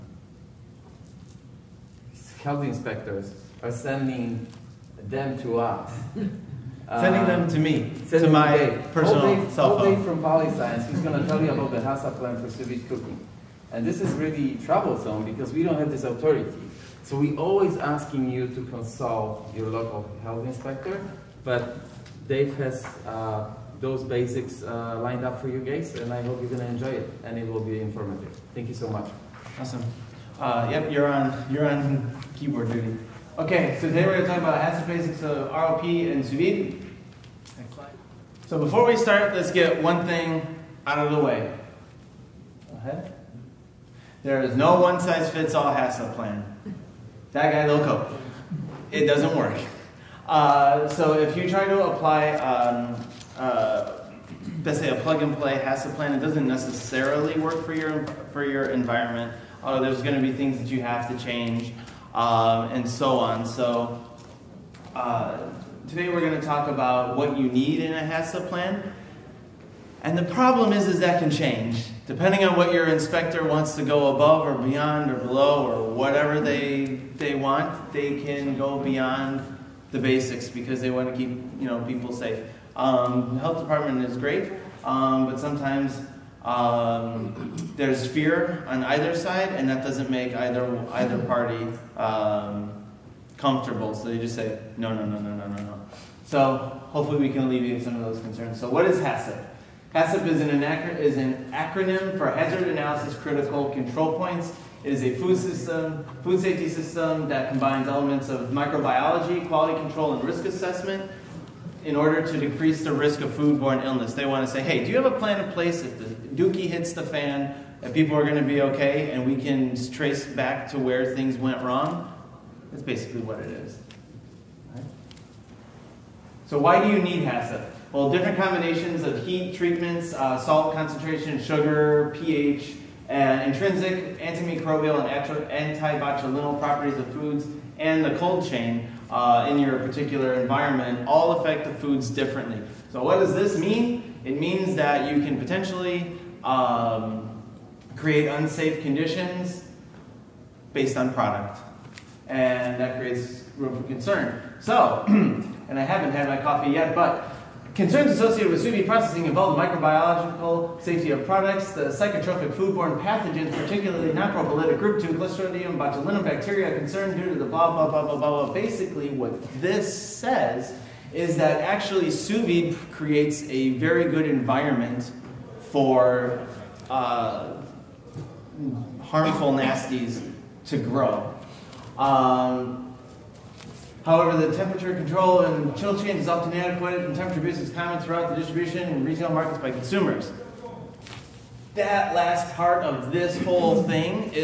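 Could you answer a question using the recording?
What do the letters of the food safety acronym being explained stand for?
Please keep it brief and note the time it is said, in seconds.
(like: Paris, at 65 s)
Hazard Analysis Critical Control Points, at 102 s.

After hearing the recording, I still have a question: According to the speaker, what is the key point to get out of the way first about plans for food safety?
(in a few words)
No one-size-fits-all HACCP plan.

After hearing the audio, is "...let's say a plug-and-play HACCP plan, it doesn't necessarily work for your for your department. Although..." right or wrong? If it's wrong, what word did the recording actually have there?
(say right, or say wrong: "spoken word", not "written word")
wrong: "environment", not "department".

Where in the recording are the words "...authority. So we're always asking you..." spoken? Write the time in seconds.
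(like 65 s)
16 s.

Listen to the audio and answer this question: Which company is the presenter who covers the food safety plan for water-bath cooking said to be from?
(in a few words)
Polyscience.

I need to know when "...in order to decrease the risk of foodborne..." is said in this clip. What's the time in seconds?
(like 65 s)
111 s.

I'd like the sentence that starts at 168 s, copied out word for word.
Basically, what this says is that actually sous vide creates a very good environment for uh, harmful nasties to grow.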